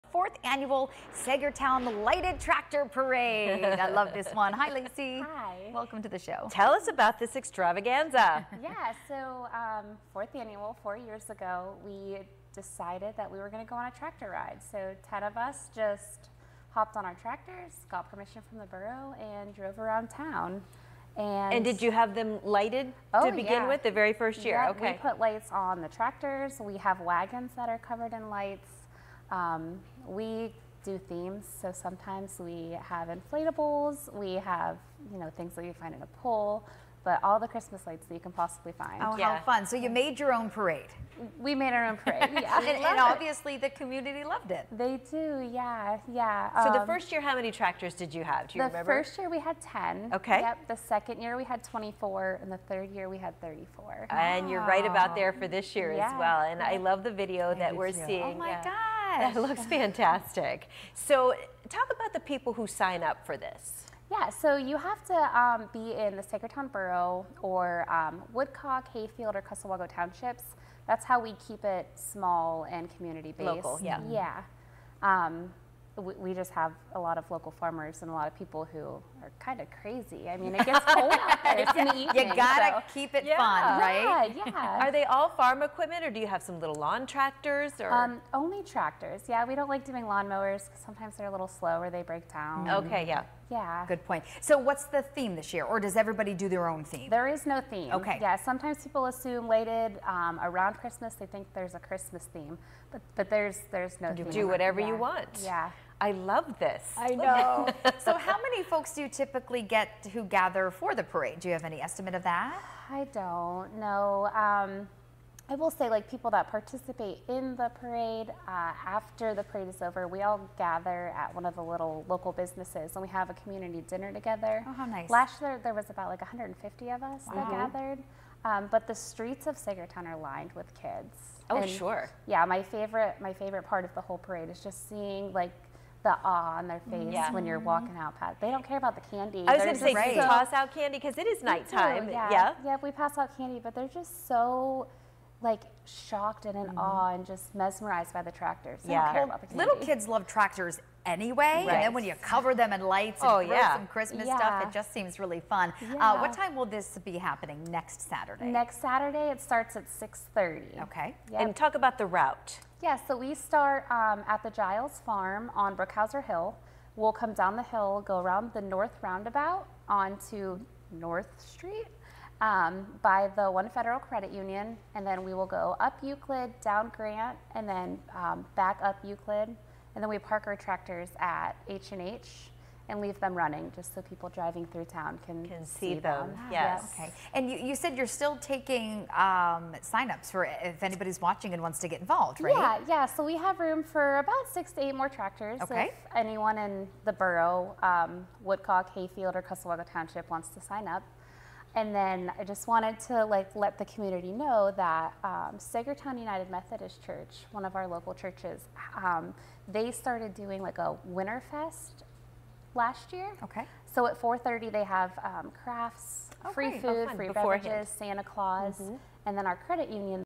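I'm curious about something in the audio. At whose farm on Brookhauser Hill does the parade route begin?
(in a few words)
Giles Farm.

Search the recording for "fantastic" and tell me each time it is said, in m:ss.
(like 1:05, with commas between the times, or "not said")
0:59.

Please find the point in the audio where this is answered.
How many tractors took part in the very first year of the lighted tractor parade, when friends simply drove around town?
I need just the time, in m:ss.
0:48.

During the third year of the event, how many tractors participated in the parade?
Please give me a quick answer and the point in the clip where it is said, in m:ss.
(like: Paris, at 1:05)
34, at 0:52.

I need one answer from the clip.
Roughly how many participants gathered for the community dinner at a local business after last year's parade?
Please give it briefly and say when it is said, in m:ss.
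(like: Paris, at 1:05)
150, at 2:05.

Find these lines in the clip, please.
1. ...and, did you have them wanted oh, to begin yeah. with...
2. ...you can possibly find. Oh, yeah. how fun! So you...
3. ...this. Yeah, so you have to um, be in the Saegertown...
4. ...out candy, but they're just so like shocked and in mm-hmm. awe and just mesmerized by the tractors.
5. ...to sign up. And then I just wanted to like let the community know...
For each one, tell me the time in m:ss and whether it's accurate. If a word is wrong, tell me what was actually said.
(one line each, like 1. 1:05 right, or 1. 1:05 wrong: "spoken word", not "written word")
1. 0:21 wrong: "lighted", not "wanted"
2. 0:38 right
3. 1:03 right
4. 2:23 right
5. 3:20 right.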